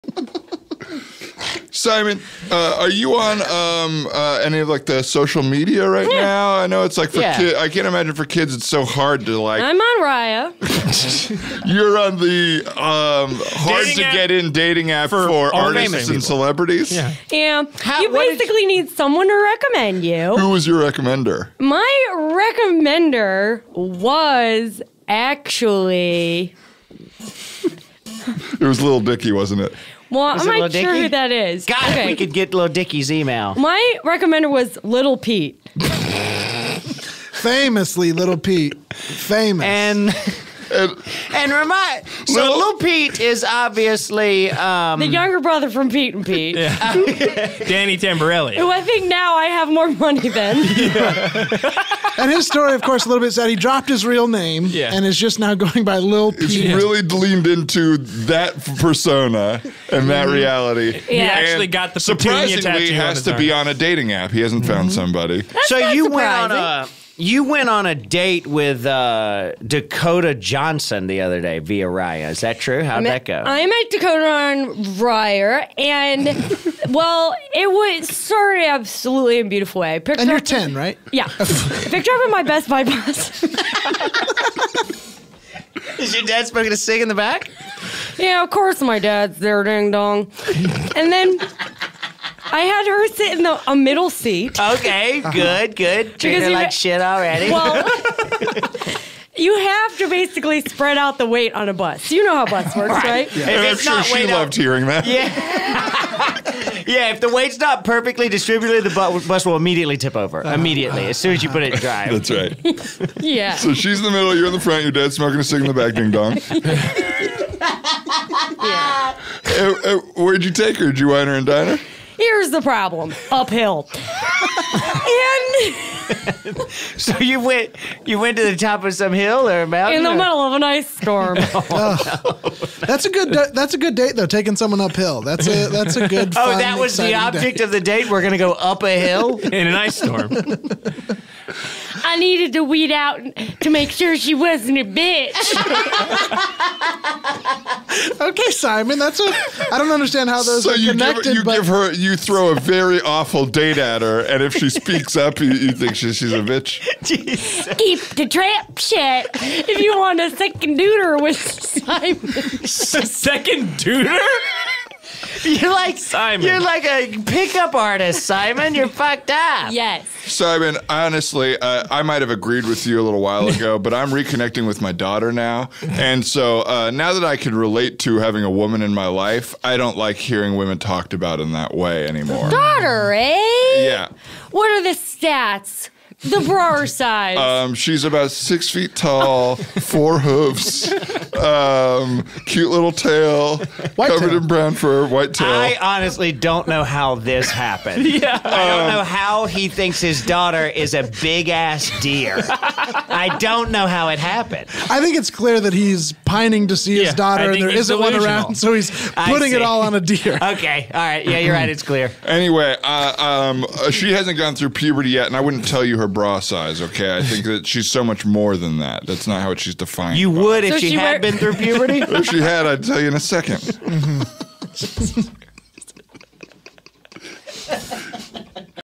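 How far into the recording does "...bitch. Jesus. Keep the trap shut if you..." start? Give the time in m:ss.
2:36.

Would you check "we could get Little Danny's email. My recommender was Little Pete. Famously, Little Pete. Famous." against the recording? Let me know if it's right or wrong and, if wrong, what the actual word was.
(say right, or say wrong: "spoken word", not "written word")
wrong: "Dicky", not "Danny".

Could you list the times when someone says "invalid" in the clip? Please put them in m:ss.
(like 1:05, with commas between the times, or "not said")
not said.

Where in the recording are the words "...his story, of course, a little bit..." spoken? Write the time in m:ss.
0:52.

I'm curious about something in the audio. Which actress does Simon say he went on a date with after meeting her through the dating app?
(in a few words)
Dakota Johnson.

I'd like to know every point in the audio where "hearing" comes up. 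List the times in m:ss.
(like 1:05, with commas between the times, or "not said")
1:44, 3:00.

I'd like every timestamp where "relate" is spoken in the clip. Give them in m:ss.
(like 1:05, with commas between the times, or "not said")
2:57.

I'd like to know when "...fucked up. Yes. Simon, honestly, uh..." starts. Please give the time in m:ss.
2:48.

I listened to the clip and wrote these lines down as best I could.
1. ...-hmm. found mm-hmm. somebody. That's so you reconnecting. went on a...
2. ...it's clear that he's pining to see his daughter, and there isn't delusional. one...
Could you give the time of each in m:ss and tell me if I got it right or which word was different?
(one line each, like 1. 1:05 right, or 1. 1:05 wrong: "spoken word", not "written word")
1. 1:04 wrong: "surprising", not "reconnecting"
2. 3:25 right.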